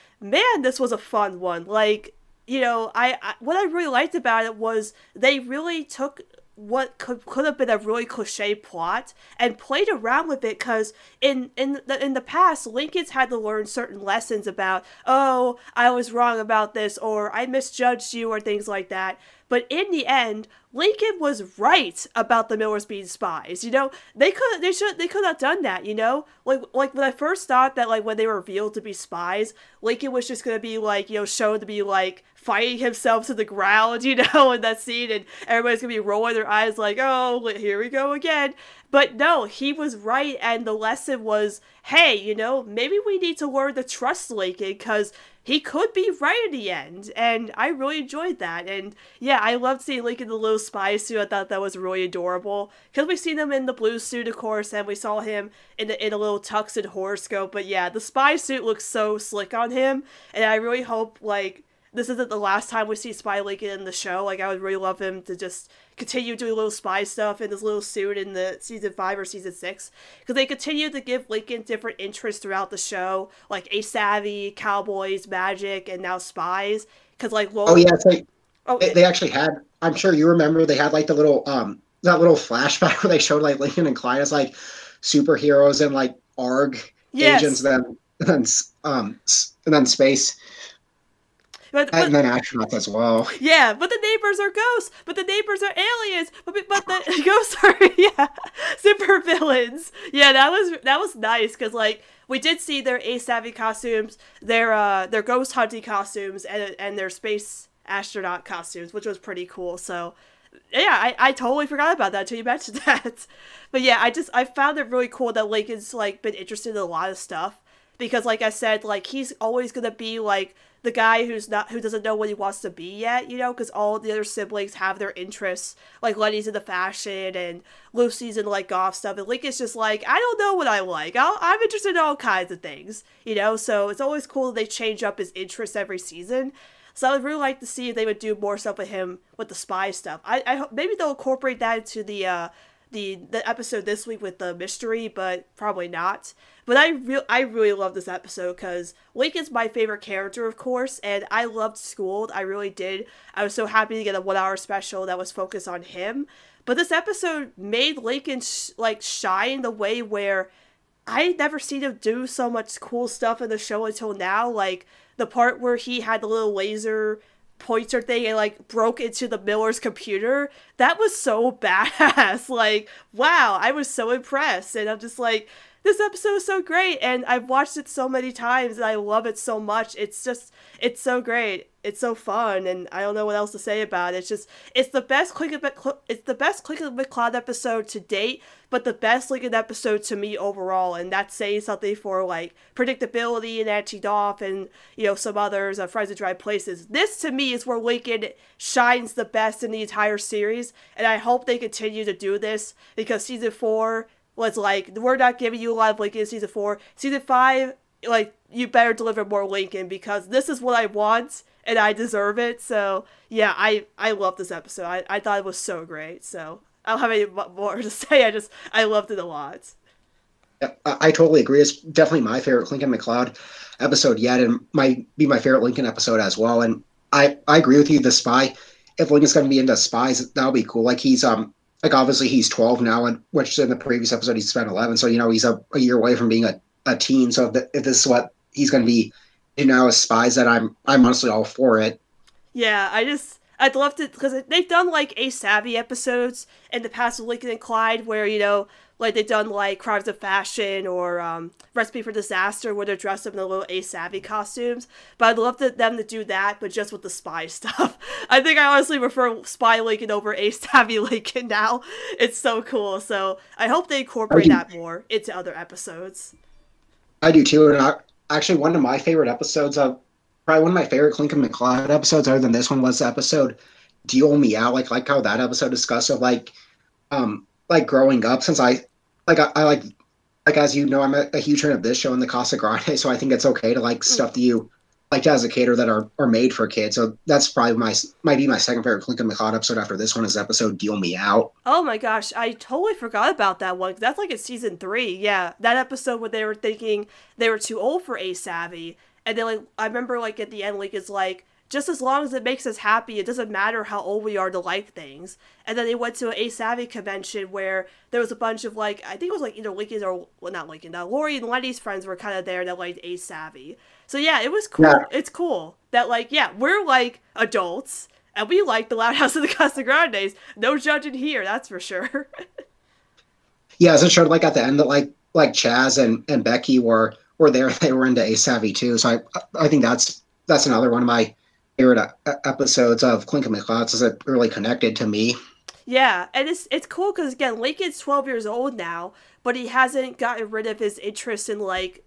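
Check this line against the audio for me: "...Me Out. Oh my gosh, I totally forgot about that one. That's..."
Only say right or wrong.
right.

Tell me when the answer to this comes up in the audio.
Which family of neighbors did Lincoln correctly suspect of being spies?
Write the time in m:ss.
0:22.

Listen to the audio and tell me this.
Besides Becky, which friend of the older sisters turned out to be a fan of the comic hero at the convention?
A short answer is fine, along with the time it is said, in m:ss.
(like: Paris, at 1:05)
Chaz, at 5:25.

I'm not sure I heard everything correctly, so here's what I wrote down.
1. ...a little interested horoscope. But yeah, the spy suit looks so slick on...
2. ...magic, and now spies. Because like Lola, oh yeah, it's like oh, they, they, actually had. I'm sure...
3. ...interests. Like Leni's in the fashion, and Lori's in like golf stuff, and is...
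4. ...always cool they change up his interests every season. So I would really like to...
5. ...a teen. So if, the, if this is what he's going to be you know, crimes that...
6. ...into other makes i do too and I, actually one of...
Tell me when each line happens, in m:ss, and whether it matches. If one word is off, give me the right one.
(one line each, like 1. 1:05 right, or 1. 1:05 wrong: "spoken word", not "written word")
1. 0:56 wrong: "tuxed", not "interested"
2. 1:15 right
3. 2:05 wrong: "Lucy", not "Lori"
4. 2:14 right
5. 3:56 wrong: "spies", not "crimes"
6. 4:25 wrong: "episodes", not "makes".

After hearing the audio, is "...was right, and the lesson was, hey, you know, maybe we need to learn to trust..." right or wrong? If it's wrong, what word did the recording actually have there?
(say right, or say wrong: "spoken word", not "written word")
right.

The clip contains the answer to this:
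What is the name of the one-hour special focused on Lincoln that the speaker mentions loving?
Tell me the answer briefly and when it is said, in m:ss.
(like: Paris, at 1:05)
Schooled, at 2:31.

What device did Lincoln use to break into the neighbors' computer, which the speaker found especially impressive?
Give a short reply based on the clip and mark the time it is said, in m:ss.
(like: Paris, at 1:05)
Laser pointer, at 2:46.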